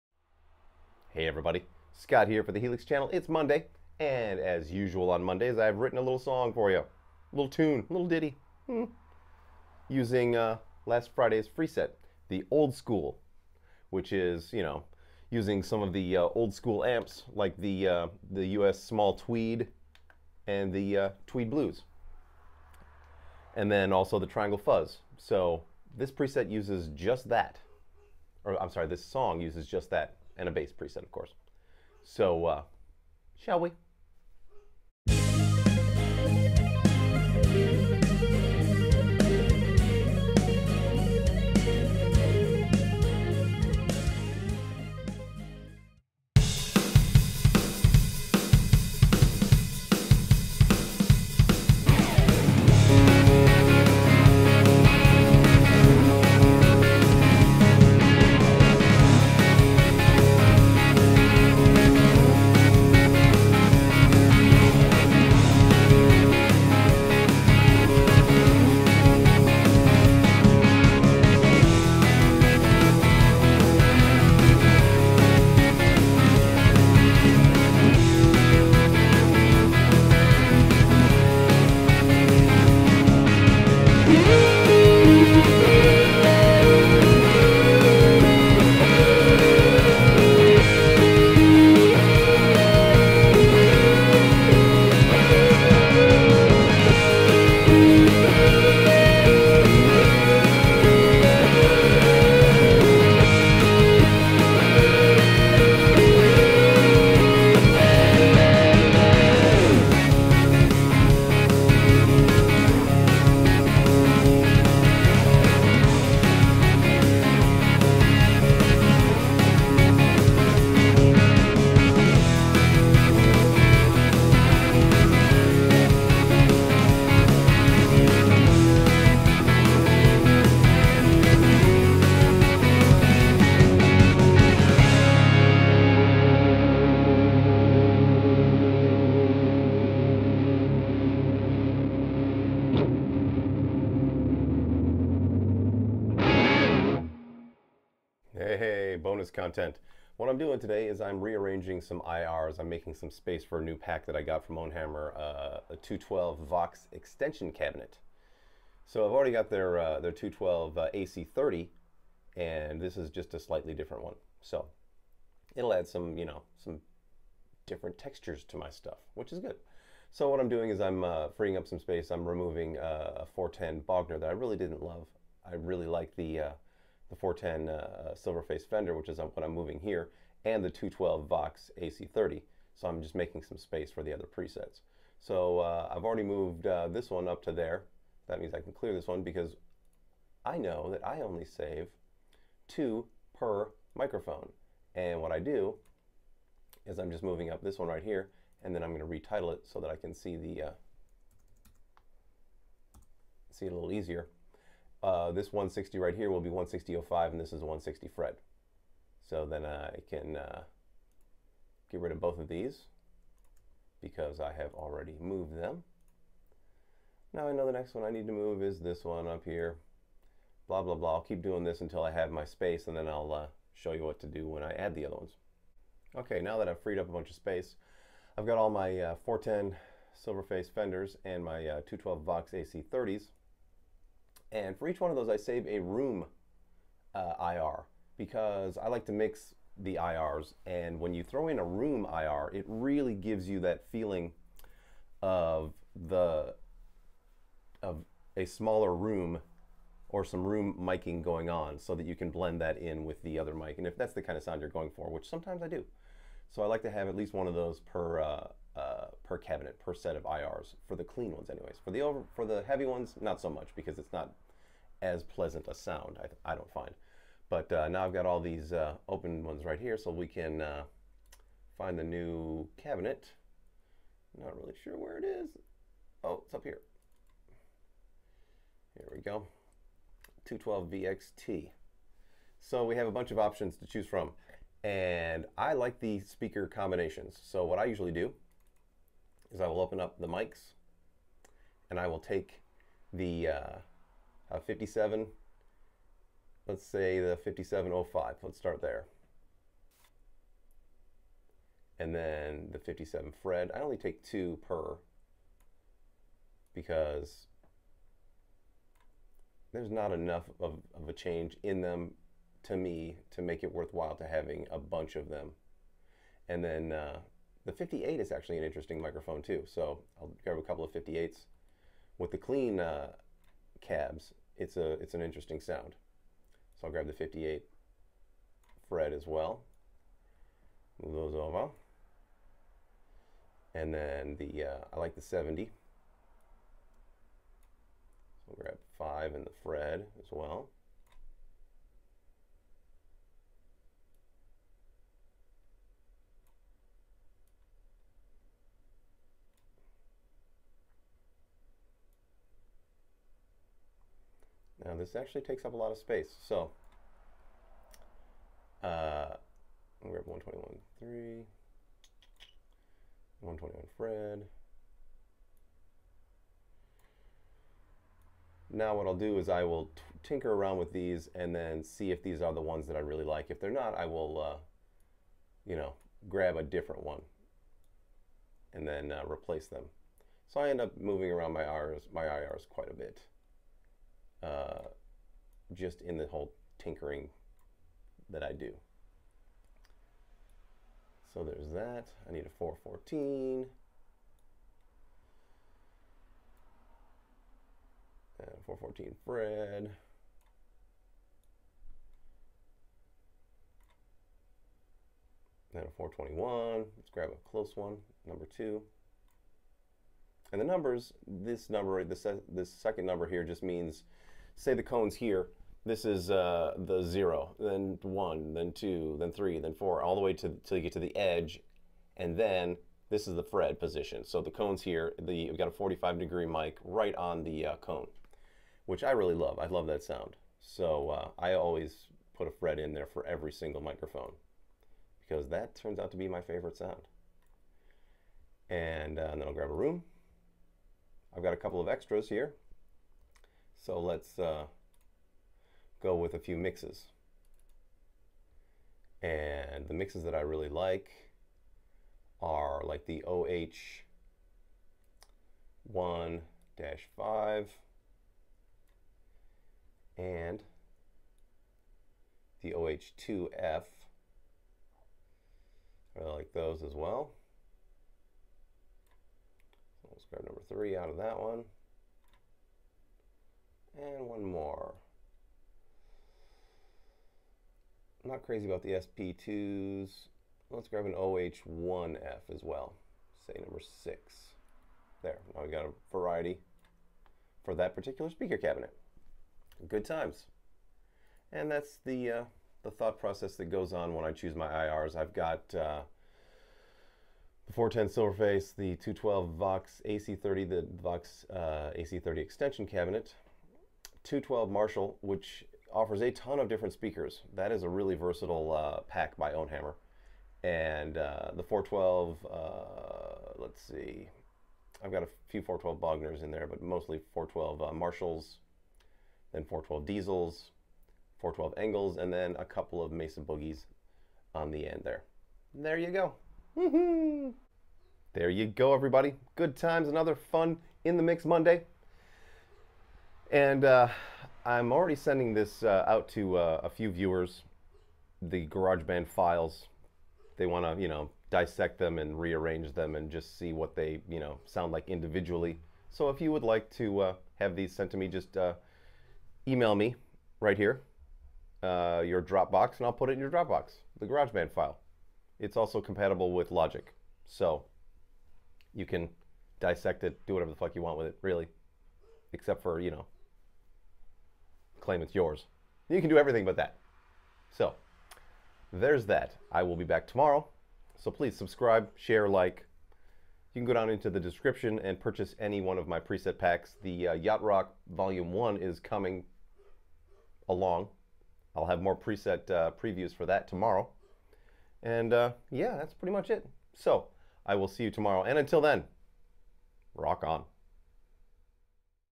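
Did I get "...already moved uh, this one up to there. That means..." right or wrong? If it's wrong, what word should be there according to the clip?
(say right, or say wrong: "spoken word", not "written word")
right.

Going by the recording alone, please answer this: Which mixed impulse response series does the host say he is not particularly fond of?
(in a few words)
SP2.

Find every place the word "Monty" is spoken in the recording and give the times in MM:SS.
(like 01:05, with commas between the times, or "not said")
not said.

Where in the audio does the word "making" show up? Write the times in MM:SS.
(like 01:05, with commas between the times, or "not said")
02:32, 03:03.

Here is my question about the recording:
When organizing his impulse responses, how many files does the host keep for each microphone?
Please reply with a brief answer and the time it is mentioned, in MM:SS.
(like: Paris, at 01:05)
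2, at 03:12.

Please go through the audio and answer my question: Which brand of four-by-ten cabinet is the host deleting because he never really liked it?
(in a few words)
Bogner.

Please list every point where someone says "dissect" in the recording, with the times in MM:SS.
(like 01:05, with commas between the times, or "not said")
09:01, 09:19.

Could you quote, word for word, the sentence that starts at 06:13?
If they're not, I will, uh, you know, grab a different one and then uh, replace them.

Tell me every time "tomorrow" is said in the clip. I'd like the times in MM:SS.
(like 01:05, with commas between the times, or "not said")
09:30, 09:43, 09:48.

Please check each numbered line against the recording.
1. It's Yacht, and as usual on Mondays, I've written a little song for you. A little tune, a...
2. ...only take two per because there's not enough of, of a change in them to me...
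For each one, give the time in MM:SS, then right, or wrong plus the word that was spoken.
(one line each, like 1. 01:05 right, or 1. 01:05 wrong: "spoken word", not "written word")
1. 00:03 wrong: "Monday", not "Yacht"
2. 05:03 right.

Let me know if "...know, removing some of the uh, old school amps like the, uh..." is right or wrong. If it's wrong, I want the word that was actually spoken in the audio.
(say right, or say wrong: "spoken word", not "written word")
wrong: "using", not "removing".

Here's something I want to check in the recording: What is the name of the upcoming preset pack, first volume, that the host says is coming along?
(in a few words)
Yacht Rock Volume 1.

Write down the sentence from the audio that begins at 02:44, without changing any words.
So it'll add some, you know, some different textures to my stuff, which is good.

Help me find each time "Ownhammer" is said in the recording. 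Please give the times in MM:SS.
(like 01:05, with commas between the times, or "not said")
02:34, 08:29.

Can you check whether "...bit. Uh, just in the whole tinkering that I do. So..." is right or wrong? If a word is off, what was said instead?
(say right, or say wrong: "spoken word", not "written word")
right.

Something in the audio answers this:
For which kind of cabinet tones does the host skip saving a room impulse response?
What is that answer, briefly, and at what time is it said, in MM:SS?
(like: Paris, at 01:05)
heavy ones, at 04:22.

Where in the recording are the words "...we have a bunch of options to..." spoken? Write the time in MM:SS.
04:42.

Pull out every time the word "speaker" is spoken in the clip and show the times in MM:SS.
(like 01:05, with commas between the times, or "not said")
04:46, 08:08, 08:26.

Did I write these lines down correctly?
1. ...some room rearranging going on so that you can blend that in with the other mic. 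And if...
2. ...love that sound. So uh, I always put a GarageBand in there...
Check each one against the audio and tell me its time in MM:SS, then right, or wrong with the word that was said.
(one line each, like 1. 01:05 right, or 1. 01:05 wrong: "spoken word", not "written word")
1. 04:10 wrong: "miking", not "rearranging"
2. 07:09 wrong: "Fred", not "GarageBand".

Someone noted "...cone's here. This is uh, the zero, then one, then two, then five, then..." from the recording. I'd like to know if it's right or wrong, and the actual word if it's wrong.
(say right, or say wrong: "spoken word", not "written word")
wrong: "three", not "five".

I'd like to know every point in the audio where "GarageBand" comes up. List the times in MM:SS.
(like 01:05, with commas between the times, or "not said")
08:58, 09:14.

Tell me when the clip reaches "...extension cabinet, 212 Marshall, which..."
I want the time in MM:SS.
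08:22.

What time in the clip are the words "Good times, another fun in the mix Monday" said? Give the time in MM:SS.
08:49.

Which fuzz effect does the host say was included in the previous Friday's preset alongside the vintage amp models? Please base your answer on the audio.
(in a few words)
Triangle Fuzz.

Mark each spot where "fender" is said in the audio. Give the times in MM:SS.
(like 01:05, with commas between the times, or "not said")
02:58, 03:50.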